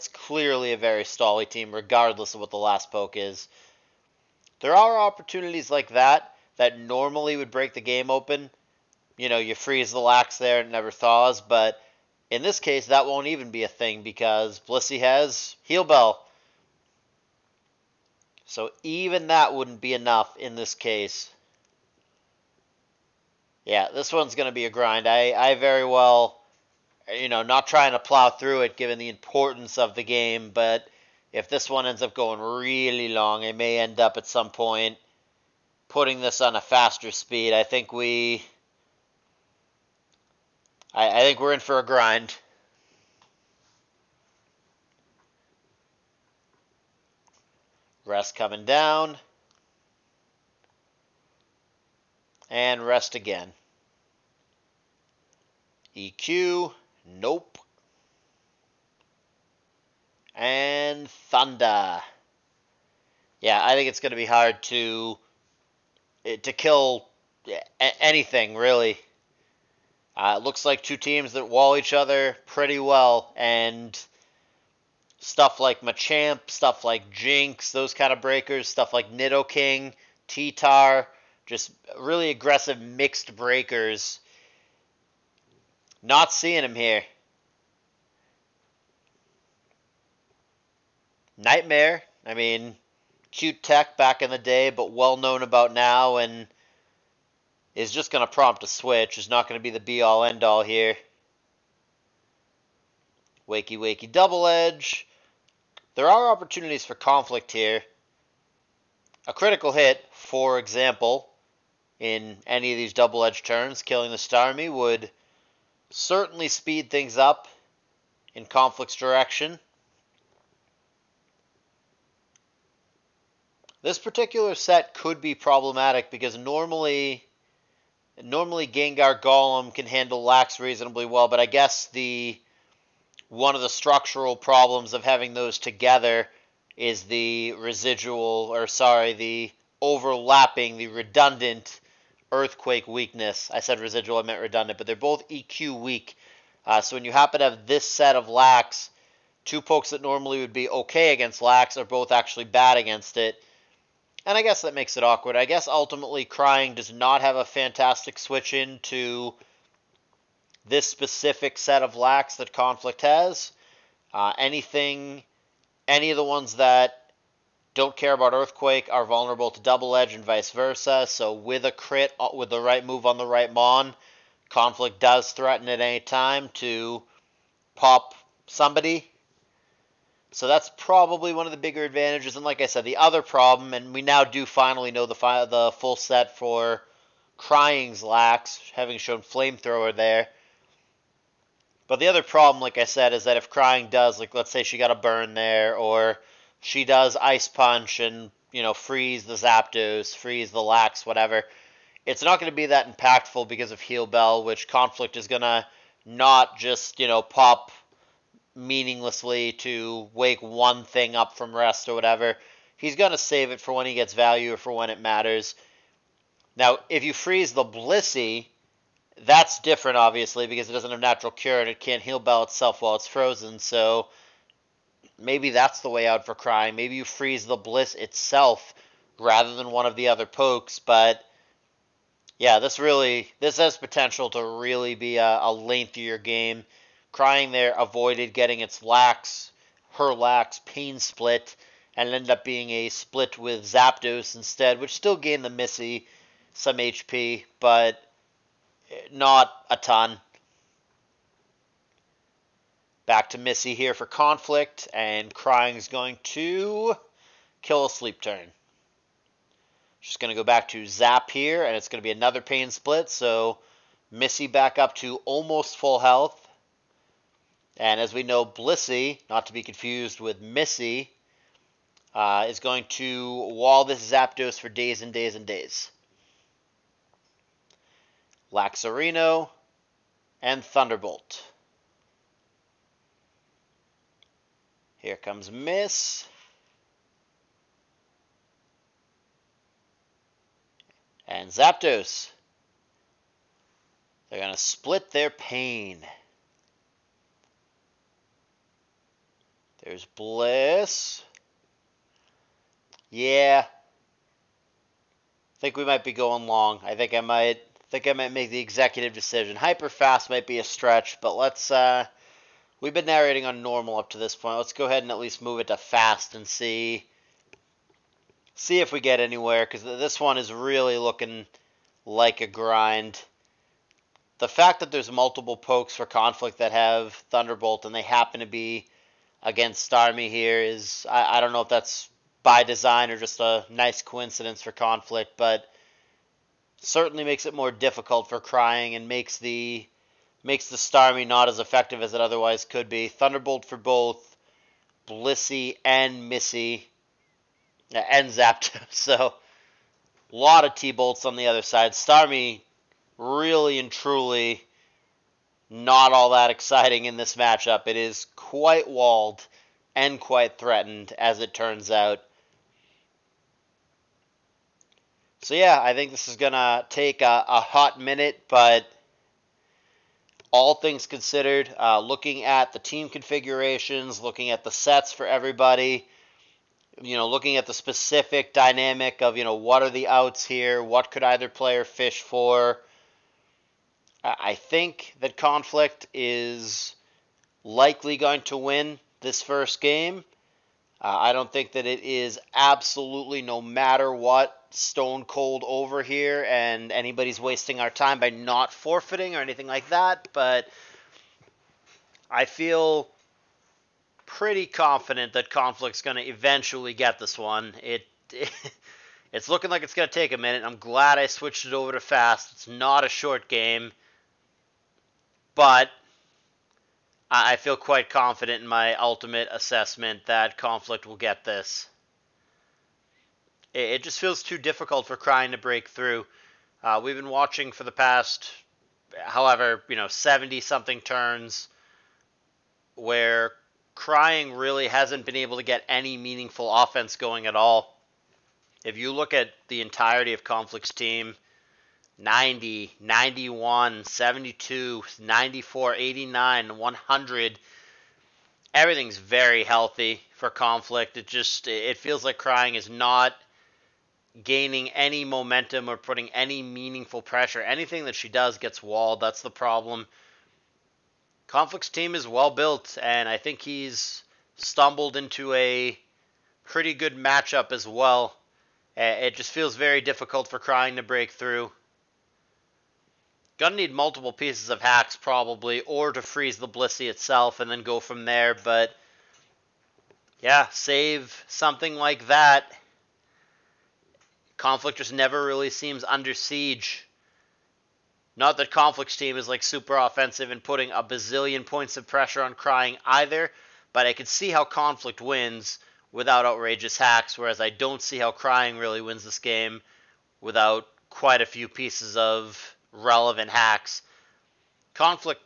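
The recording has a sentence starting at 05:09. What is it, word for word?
Hyper fast might be a stretch, but let's uh we've been narrating on normal up to this point.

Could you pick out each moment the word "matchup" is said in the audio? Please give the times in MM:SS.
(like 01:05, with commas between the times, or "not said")
05:57, 07:47.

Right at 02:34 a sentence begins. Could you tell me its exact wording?
And I guess that makes it awkward.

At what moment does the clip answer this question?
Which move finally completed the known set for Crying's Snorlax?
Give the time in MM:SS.
03:09.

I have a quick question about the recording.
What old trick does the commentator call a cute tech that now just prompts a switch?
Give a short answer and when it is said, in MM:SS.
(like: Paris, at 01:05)
Nightmare, at 01:31.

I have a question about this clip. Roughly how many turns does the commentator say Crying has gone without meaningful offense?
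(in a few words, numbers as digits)
70 something.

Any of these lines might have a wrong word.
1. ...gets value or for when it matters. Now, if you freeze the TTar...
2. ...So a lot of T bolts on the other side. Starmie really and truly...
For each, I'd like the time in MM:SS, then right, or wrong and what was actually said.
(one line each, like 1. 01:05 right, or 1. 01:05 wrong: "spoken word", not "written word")
1. 03:33 wrong: "Blissey", not "TTar"
2. 05:48 right.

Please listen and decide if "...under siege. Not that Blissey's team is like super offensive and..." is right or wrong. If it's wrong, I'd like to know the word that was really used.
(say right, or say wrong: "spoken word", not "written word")
wrong: "Conflict", not "Blissey".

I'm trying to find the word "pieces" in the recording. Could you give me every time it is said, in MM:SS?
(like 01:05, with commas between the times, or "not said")
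07:54, 08:21.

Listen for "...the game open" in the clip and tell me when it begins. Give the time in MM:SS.
00:07.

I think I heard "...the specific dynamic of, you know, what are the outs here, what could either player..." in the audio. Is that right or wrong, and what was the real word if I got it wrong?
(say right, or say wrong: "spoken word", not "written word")
right.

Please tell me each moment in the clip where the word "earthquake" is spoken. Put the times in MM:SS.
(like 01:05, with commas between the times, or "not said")
02:22, 02:48.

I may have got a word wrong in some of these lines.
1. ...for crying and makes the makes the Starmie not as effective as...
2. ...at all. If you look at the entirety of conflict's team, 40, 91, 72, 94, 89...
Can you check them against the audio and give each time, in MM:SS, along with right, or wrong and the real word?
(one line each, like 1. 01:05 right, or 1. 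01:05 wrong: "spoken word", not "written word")
1. 05:38 right
2. 07:17 wrong: "90", not "40".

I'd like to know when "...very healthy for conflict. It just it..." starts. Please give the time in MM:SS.
07:29.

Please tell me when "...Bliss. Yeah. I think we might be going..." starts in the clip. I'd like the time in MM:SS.
05:00.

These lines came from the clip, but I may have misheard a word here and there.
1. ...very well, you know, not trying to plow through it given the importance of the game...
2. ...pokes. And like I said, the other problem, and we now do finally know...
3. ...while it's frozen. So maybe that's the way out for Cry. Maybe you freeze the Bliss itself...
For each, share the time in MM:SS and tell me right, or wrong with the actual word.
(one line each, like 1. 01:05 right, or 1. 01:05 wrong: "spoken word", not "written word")
1. 00:25 right
2. 03:01 wrong: "advantages", not "pokes"
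3. 03:42 right.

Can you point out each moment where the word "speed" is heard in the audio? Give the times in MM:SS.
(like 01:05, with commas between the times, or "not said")
00:37, 01:56.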